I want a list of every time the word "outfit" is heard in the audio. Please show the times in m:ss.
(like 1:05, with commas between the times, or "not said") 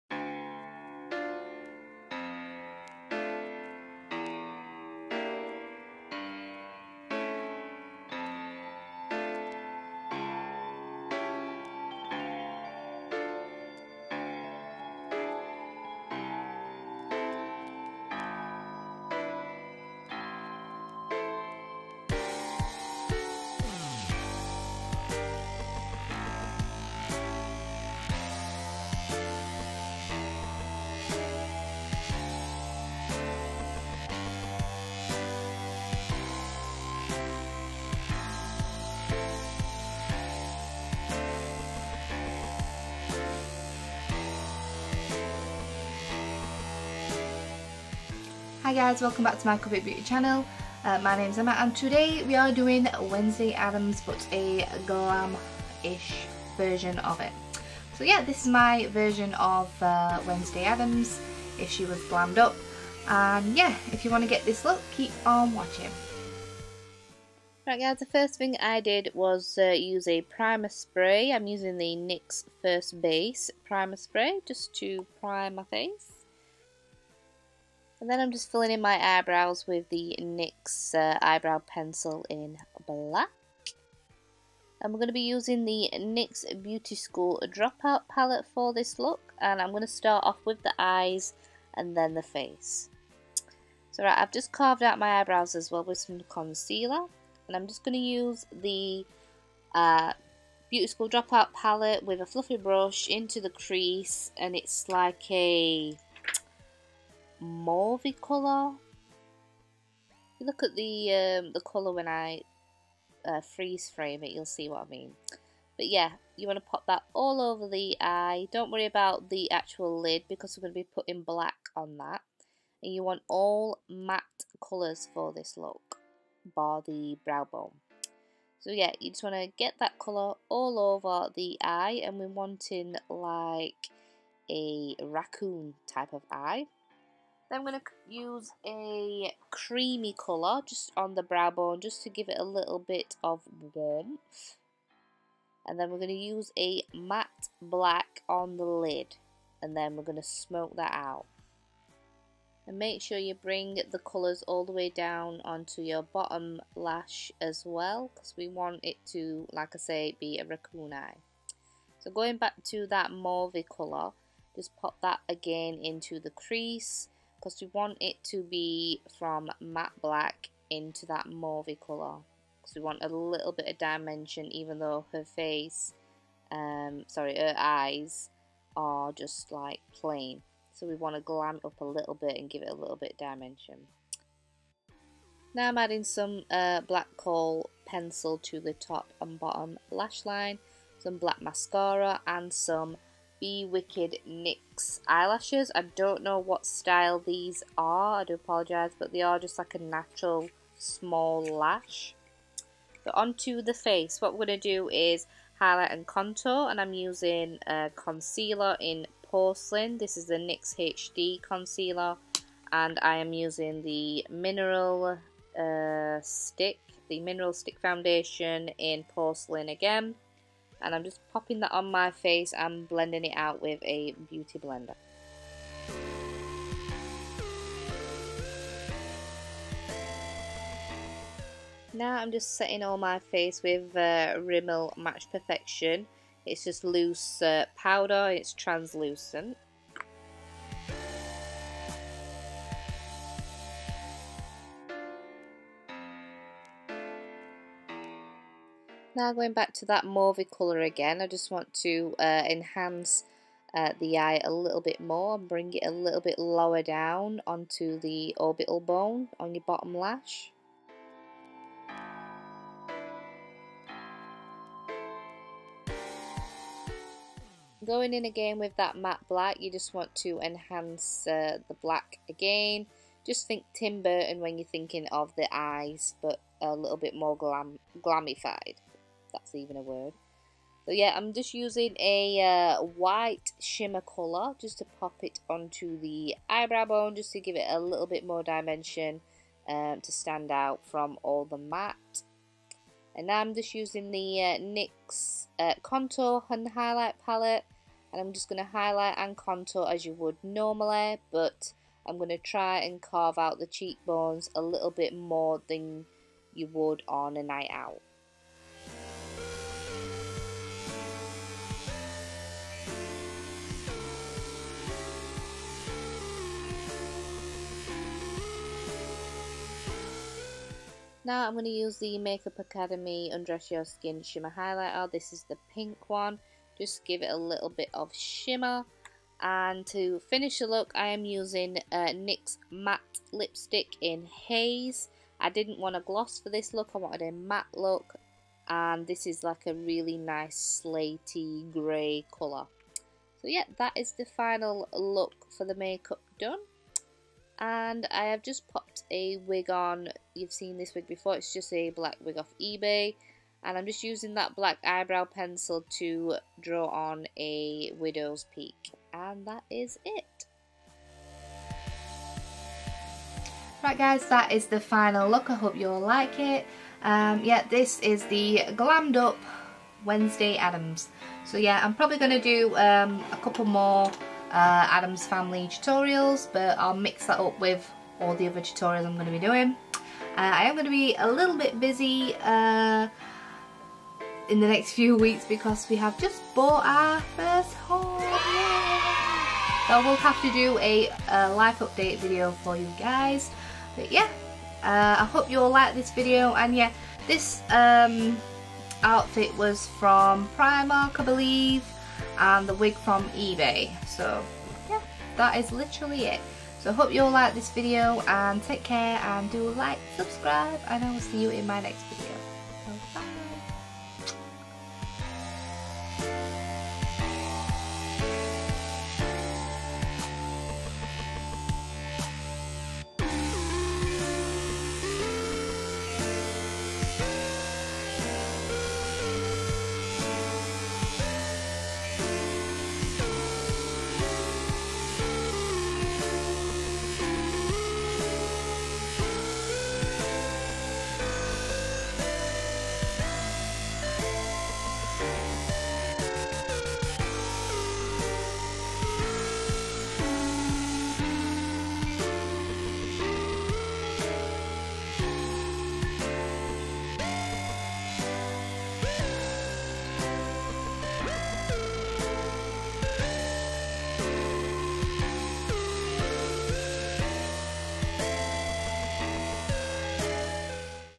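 6:39.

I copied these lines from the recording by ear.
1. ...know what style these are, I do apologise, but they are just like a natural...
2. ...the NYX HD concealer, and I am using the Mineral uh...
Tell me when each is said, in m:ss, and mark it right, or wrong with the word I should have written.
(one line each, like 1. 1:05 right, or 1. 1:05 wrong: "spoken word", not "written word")
1. 3:16 right
2. 3:30 right.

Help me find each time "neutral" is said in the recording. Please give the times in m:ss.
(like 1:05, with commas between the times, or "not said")
not said.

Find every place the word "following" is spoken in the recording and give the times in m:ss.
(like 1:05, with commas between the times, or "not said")
not said.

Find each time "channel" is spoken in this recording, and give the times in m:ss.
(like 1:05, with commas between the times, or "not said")
0:50.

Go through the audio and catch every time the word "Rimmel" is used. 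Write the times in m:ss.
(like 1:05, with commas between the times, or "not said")
3:54.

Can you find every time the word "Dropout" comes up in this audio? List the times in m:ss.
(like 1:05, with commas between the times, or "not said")
1:27, 1:41.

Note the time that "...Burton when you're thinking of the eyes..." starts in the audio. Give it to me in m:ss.
4:34.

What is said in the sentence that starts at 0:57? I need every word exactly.
So yeah, this is my version of uh, Wednesday Adams if she was glammed up.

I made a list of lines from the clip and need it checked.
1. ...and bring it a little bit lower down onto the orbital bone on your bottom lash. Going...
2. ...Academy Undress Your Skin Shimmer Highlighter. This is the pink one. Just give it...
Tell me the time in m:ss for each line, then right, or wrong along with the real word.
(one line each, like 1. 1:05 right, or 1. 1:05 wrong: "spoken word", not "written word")
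1. 4:15 right
2. 5:22 right.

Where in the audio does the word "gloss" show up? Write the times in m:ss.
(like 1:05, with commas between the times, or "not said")
5:35.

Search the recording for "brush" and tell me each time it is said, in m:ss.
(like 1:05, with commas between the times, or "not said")
1:42.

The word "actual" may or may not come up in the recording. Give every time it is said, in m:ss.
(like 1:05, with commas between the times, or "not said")
1:59.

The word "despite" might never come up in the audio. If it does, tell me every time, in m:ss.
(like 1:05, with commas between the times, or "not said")
not said.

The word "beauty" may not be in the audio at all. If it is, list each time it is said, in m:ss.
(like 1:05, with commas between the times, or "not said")
0:49, 1:26, 1:40, 3:44.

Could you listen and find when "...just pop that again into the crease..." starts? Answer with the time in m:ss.
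2:44.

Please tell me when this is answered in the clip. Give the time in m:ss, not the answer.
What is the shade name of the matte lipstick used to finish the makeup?
5:34.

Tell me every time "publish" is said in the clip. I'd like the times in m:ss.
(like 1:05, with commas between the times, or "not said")
not said.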